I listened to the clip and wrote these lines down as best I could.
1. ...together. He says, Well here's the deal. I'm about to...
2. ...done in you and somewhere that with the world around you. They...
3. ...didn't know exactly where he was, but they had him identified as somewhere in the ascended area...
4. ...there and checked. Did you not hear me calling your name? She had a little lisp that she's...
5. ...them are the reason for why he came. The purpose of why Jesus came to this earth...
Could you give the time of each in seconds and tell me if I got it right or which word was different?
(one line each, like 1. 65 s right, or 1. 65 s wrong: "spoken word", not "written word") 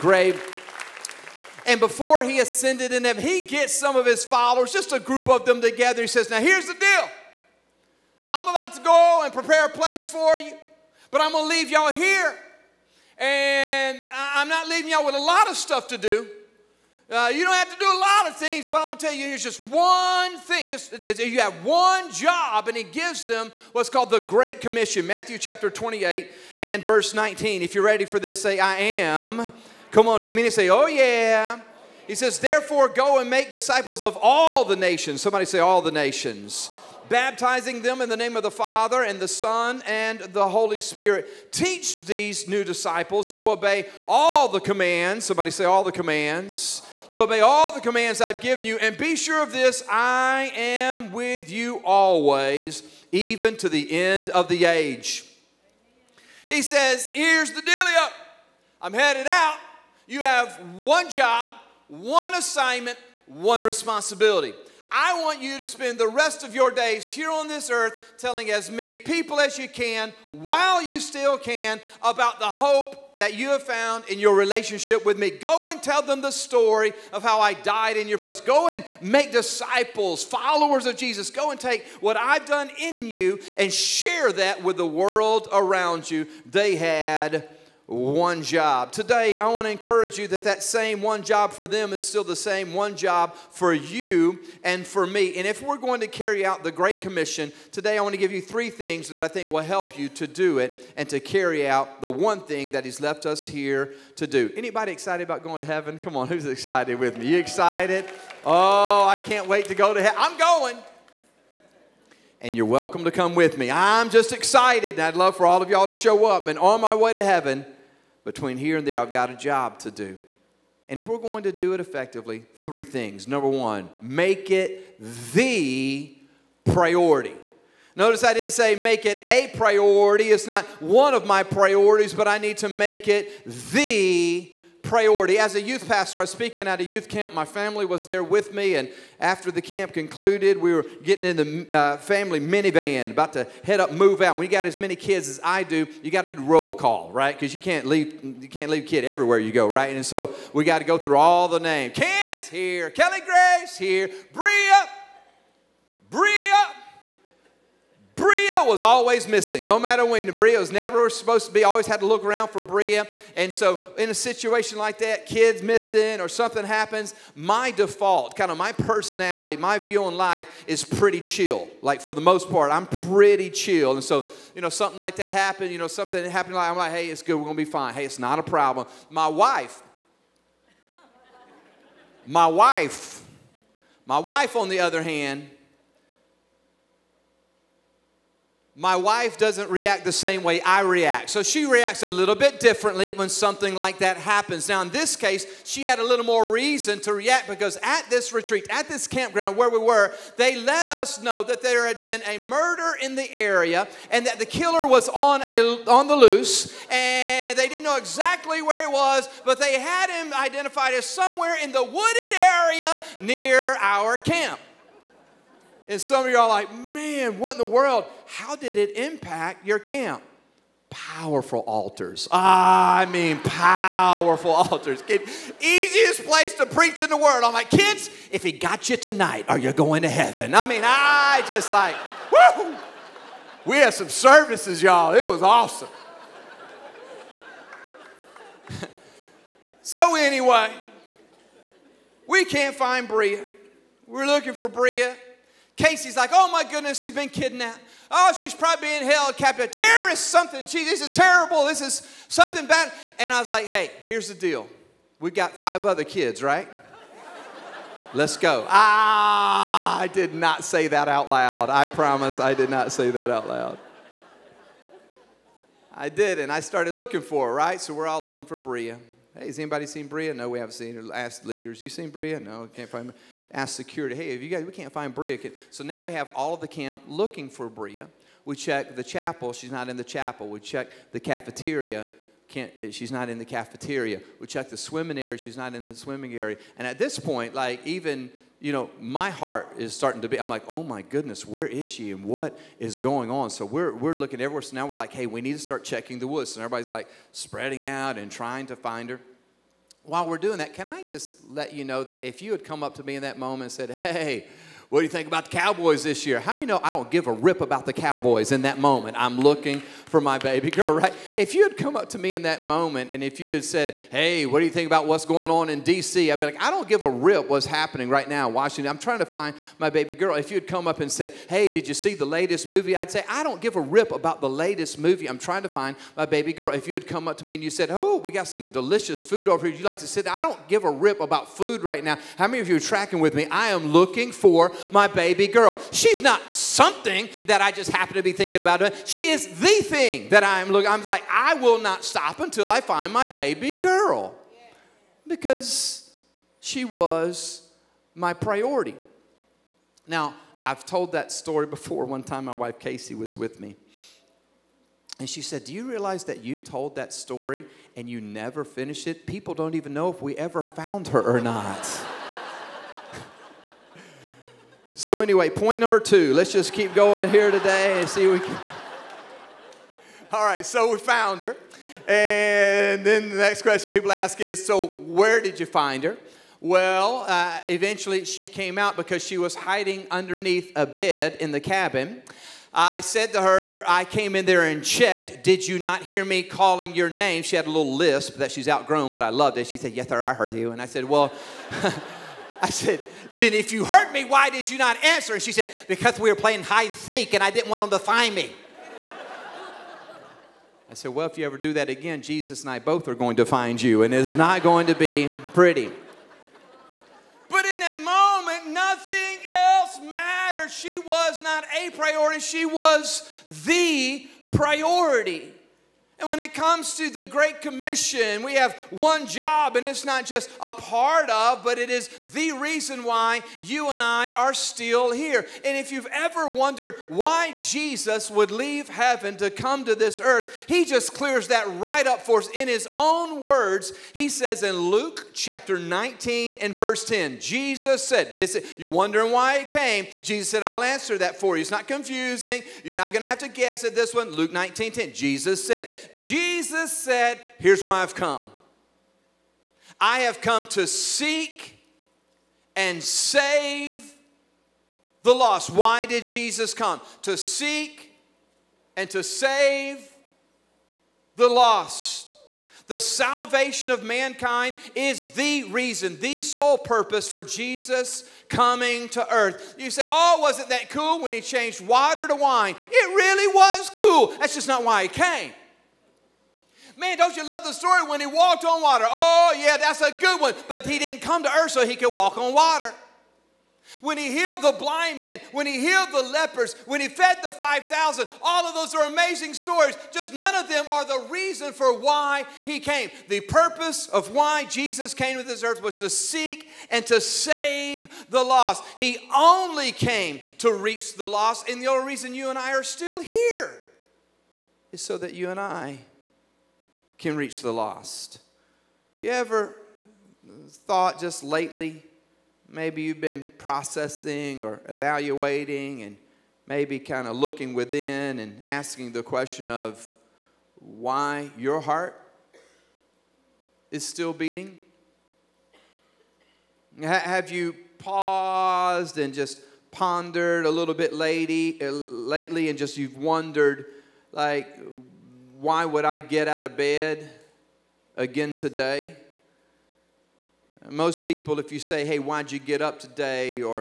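1. 5 s wrong: "Now", not "Well"
2. 82 s wrong: "share", not "somewhere"
3. 207 s wrong: "wooded", not "ascended"
4. 384 s right
5. 490 s right.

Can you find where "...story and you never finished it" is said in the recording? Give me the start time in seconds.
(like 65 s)
357 s.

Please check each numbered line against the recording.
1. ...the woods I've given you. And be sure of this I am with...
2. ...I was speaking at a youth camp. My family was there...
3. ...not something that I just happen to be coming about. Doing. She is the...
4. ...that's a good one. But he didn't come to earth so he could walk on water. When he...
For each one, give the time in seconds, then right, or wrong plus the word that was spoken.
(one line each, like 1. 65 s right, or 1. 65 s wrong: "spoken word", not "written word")
1. 47 s wrong: "commands", not "woods"
2. 136 s right
3. 336 s wrong: "thinking", not "coming"
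4. 479 s right.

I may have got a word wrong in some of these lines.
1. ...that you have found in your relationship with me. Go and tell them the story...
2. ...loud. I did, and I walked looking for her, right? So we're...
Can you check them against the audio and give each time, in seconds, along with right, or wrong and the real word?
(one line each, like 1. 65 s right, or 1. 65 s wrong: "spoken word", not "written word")
1. 73 s right
2. 263 s wrong: "started", not "walked".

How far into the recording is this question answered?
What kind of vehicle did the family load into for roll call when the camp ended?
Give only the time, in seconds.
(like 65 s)
142 s.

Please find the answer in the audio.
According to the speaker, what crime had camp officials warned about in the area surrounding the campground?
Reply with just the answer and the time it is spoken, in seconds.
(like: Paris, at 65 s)
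a murder, at 202 s.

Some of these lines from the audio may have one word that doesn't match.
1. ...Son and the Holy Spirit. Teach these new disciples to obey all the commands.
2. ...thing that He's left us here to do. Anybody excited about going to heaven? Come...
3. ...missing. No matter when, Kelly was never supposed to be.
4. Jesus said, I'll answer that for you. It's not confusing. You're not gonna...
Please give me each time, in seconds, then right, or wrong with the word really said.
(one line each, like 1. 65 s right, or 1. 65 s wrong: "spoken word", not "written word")
1. 39 s right
2. 102 s right
3. 159 s wrong: "Bria", not "Kelly"
4. 440 s right.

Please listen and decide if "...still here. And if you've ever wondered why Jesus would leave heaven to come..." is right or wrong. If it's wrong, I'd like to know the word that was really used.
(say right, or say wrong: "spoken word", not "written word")
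right.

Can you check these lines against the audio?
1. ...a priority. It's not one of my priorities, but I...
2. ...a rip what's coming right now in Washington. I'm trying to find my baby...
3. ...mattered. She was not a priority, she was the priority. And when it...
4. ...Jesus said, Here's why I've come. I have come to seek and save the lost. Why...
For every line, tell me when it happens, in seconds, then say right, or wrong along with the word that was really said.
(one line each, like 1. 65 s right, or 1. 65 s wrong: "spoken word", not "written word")
1. 129 s right
2. 317 s wrong: "happening", not "coming"
3. 410 s right
4. 446 s right.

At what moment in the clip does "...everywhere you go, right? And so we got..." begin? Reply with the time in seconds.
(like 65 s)
149 s.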